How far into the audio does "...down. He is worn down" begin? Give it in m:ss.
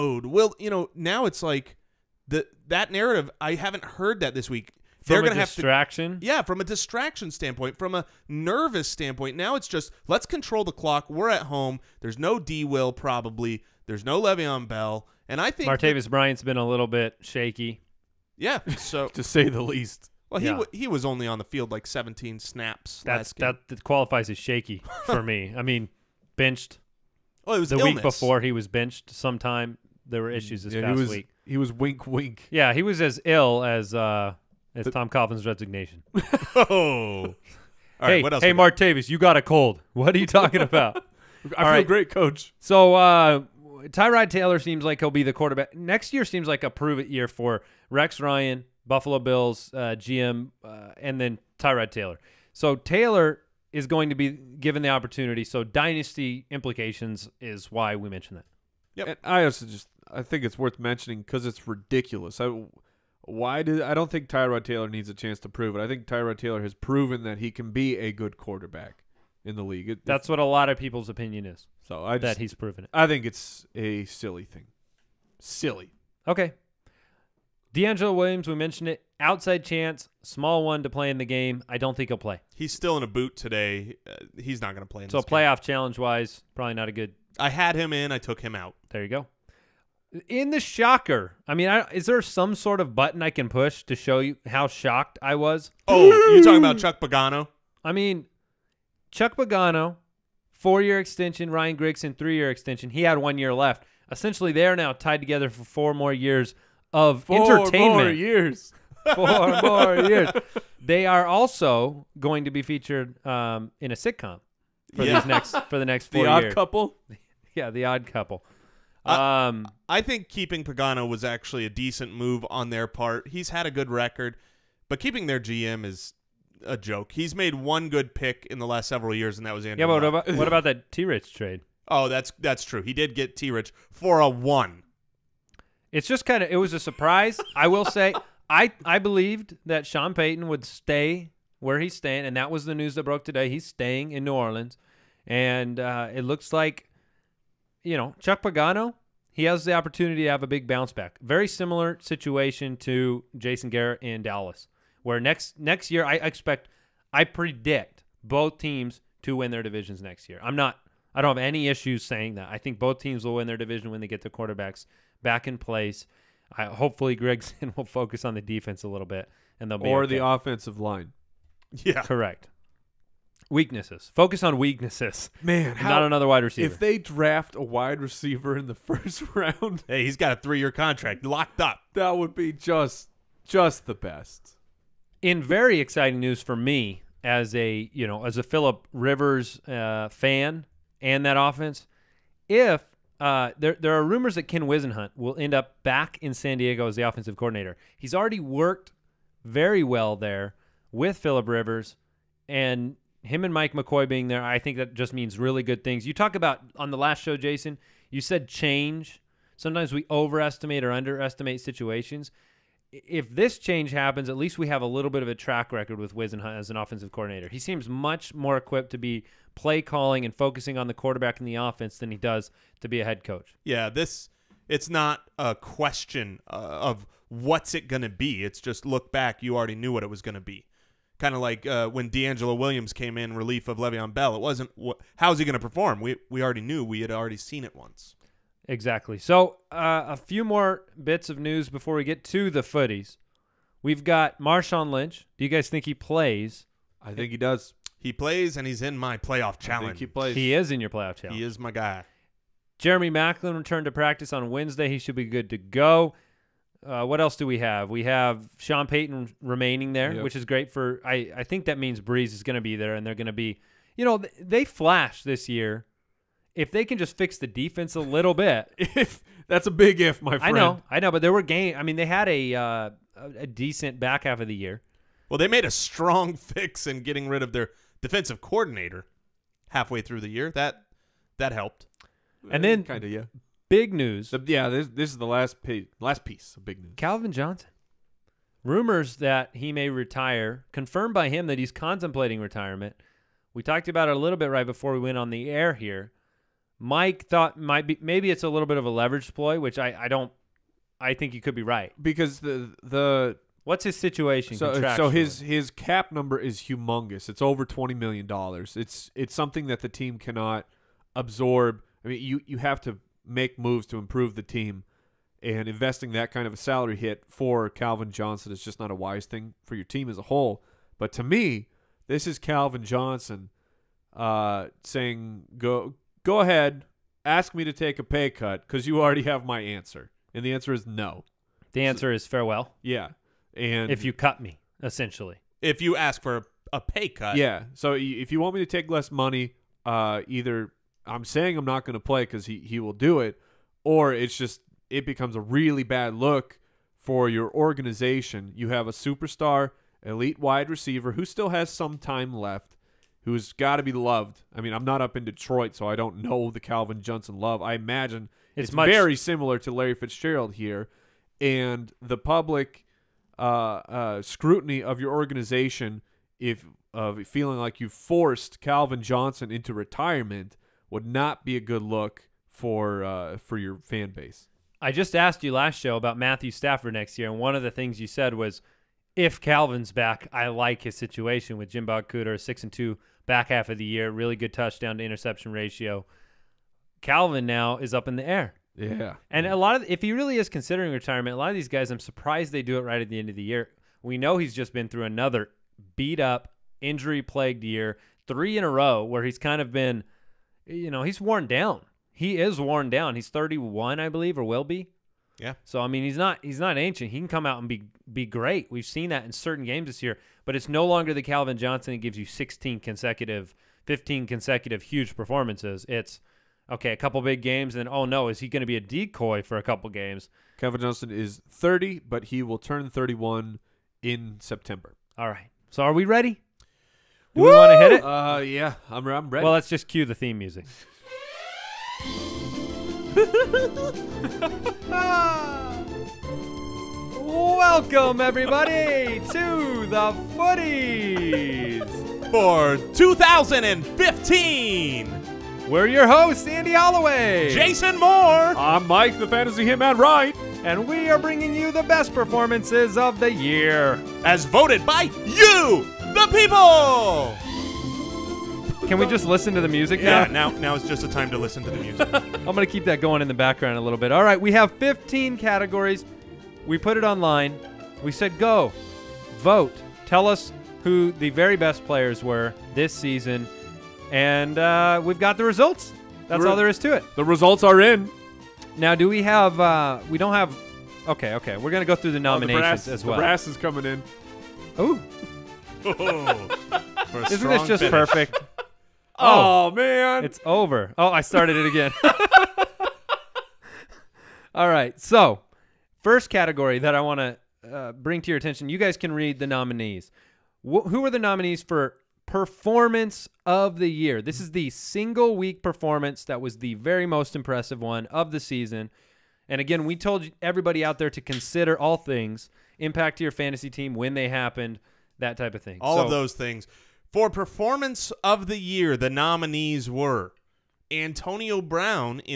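6:41.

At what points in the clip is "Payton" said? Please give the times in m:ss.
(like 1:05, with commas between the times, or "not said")
2:20, 4:18.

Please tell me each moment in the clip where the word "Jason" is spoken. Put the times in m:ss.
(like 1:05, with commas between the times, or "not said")
2:33, 3:27, 7:27.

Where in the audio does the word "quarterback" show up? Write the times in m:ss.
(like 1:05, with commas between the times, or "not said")
0:45, 1:08, 2:44, 3:40.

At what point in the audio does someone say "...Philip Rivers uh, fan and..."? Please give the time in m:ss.
3:08.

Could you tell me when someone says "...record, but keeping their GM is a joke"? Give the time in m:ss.
2:03.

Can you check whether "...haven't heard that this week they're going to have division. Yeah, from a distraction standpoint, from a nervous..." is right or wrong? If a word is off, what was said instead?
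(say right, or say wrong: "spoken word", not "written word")
wrong: "distraction", not "division".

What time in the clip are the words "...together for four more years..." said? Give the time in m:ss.
1:45.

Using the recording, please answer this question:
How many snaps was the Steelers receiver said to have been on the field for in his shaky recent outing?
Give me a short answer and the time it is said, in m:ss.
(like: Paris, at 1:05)
17, at 0:21.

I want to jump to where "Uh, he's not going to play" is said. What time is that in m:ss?
1:24.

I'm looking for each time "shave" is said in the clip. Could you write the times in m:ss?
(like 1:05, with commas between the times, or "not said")
not said.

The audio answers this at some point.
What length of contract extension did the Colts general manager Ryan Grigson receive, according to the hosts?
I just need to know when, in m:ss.
1:42.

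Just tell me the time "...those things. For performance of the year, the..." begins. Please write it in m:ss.
8:36.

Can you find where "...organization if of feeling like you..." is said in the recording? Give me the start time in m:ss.
6:05.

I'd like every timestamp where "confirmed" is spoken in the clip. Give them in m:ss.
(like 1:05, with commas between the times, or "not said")
4:50.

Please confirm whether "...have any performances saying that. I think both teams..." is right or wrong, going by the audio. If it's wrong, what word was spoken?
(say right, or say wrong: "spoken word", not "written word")
wrong: "issues", not "performances".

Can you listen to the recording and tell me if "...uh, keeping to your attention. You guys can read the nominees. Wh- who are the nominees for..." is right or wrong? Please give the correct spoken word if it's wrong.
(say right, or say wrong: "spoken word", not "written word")
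wrong: "bring", not "keeping".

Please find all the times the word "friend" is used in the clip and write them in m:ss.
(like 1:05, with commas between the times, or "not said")
4:30.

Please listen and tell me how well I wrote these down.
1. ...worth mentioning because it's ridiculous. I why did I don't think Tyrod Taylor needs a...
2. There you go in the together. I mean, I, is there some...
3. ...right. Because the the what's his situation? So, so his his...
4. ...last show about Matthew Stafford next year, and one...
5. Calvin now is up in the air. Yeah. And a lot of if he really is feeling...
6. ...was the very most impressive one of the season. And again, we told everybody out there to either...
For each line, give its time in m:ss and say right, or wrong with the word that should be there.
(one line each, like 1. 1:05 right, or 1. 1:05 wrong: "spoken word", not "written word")
1. 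1:00 right
2. 1:28 wrong: "shocker", not "together"
3. 5:01 right
4. 6:15 right
5. 6:27 wrong: "considering", not "feeling"
6. 8:26 wrong: "consider", not "either".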